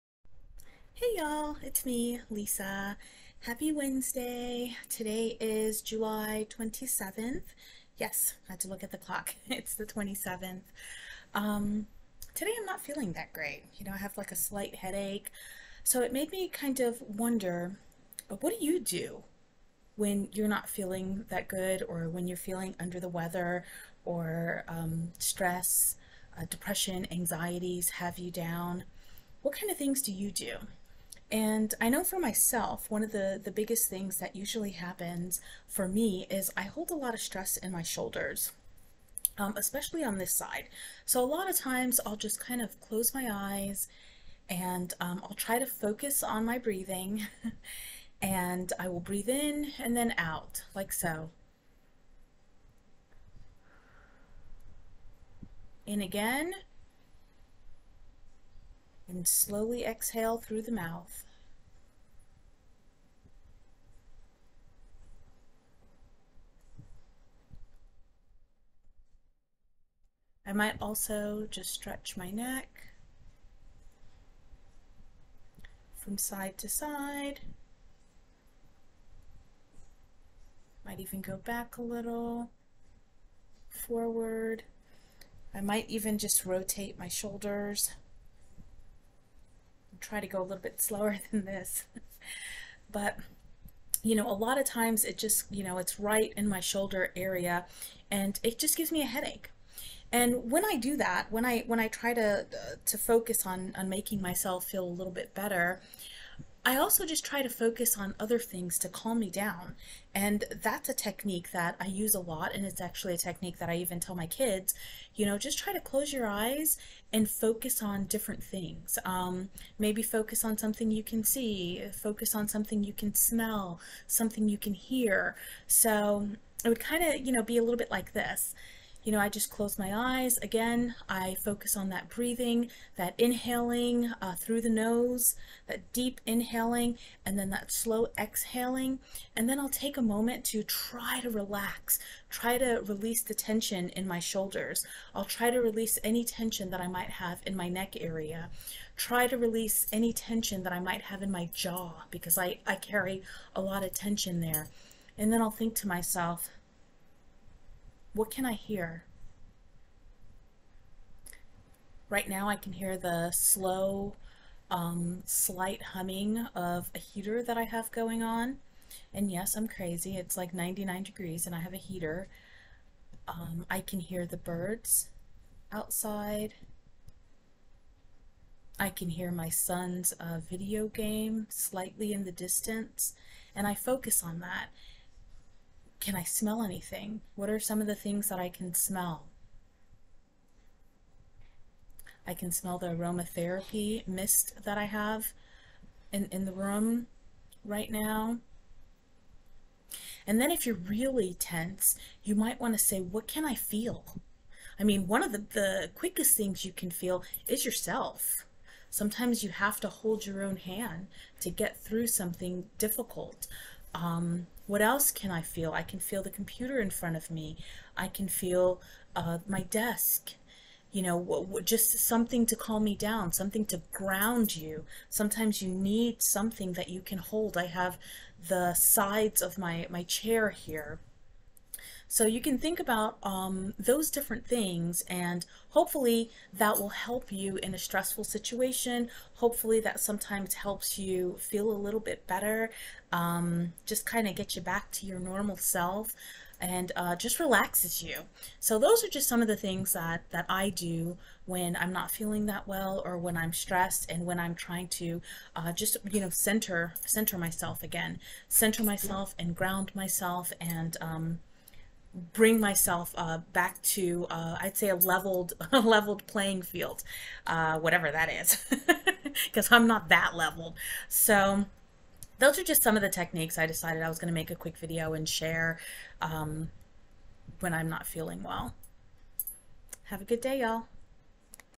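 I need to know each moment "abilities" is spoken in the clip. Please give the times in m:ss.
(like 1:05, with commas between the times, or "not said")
not said.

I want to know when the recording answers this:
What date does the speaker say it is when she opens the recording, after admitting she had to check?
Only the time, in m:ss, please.
0:05.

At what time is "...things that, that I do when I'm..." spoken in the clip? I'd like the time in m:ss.
4:09.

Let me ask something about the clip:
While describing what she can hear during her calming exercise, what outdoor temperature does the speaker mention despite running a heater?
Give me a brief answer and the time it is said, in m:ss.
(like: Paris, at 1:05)
99 degrees, at 2:50.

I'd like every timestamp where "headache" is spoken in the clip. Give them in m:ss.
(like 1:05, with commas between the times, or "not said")
0:14, 1:39.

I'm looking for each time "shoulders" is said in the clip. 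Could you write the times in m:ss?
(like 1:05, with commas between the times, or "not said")
0:37, 1:27, 1:36, 2:24.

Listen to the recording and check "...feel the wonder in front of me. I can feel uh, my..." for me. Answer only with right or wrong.
wrong.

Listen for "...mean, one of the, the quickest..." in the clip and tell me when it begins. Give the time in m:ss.
3:24.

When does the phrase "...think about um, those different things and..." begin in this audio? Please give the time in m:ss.
3:52.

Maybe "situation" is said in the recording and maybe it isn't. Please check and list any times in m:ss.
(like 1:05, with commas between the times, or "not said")
3:58.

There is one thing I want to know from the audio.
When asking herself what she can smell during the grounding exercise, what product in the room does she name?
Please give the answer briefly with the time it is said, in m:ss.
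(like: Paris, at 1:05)
aromatherapy mist, at 3:12.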